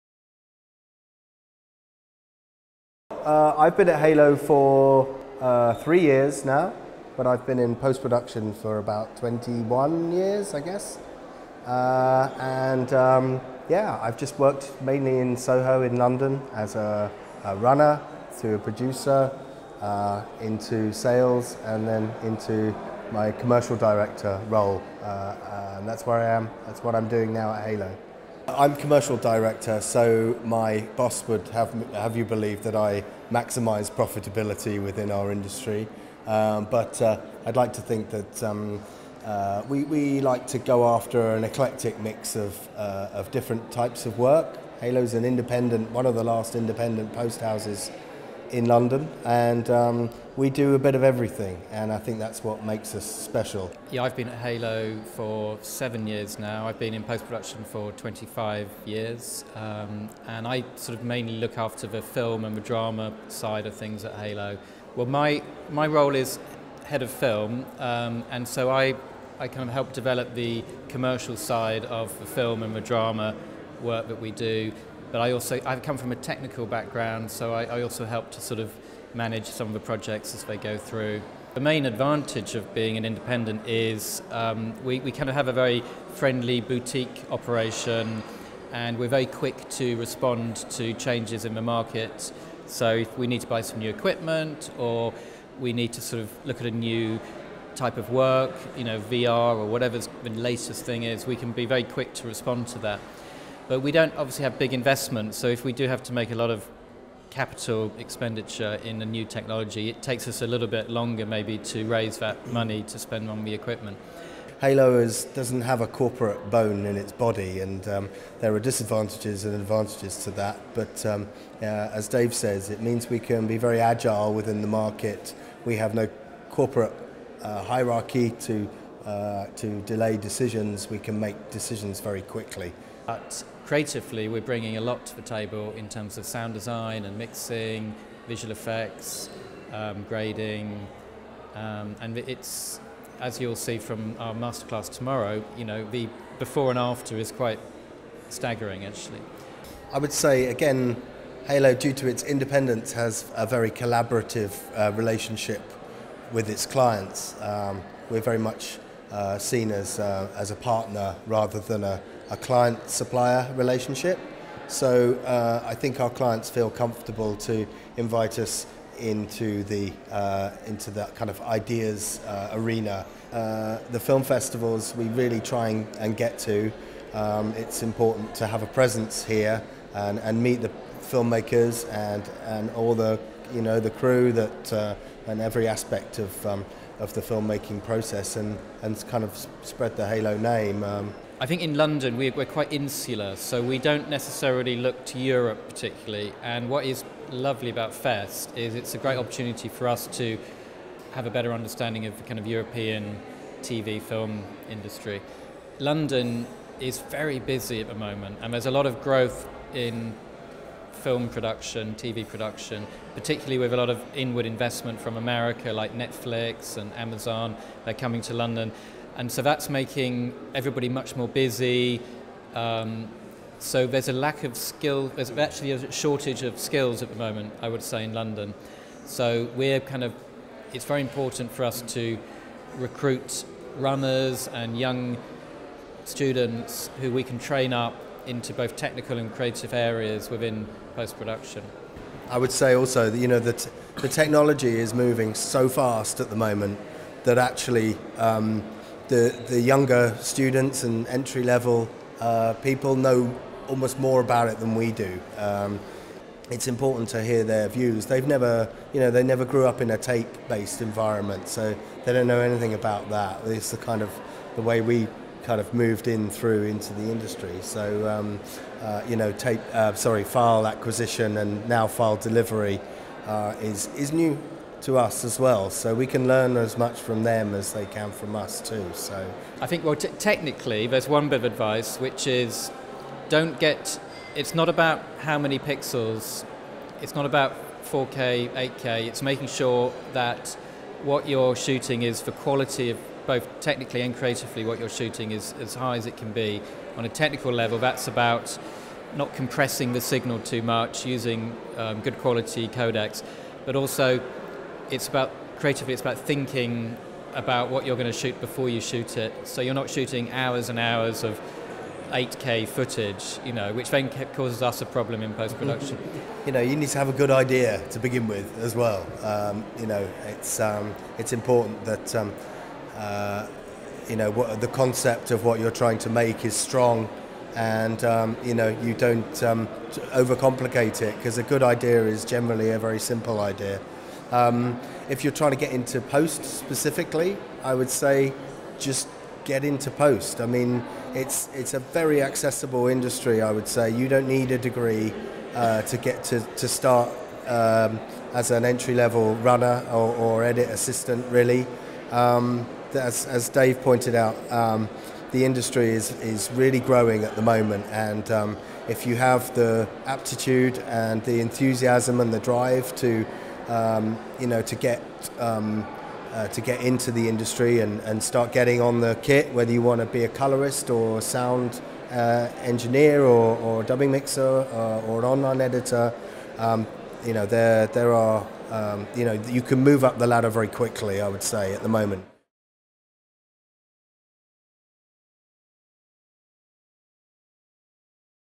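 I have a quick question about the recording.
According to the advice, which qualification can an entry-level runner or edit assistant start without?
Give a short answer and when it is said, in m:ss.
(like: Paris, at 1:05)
A degree, at 5:44.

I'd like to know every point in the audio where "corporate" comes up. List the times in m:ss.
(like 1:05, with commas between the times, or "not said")
1:55, 2:06.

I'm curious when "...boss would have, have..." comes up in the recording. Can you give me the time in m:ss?
0:30.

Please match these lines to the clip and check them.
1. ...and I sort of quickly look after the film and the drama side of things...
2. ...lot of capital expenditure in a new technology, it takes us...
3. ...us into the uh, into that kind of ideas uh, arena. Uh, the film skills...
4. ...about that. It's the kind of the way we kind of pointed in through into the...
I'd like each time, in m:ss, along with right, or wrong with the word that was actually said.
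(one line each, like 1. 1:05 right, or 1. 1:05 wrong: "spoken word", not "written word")
1. 1:00 wrong: "mainly", not "quickly"
2. 1:46 right
3. 2:48 wrong: "festivals", not "skills"
4. 4:22 wrong: "moved", not "pointed".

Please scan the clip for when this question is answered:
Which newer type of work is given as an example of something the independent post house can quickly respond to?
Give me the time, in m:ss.
1:39.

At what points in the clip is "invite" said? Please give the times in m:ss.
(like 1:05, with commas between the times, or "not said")
2:47.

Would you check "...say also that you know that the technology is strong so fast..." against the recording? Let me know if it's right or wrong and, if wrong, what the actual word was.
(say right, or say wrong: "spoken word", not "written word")
wrong: "moving", not "strong".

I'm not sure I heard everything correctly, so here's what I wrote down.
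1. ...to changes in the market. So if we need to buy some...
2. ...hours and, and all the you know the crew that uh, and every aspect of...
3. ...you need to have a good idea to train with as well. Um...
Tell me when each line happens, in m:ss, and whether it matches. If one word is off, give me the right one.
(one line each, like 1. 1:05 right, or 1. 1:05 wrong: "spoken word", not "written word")
1. 1:30 right
2. 3:01 wrong: "filmmakers", not "hours"
3. 5:16 wrong: "begin", not "train".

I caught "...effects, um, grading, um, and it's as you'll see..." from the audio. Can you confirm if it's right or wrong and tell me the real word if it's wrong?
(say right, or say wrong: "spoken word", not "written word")
right.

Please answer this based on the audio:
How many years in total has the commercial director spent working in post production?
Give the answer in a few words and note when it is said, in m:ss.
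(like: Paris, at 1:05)
21, at 0:09.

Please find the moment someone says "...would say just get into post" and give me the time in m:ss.
5:37.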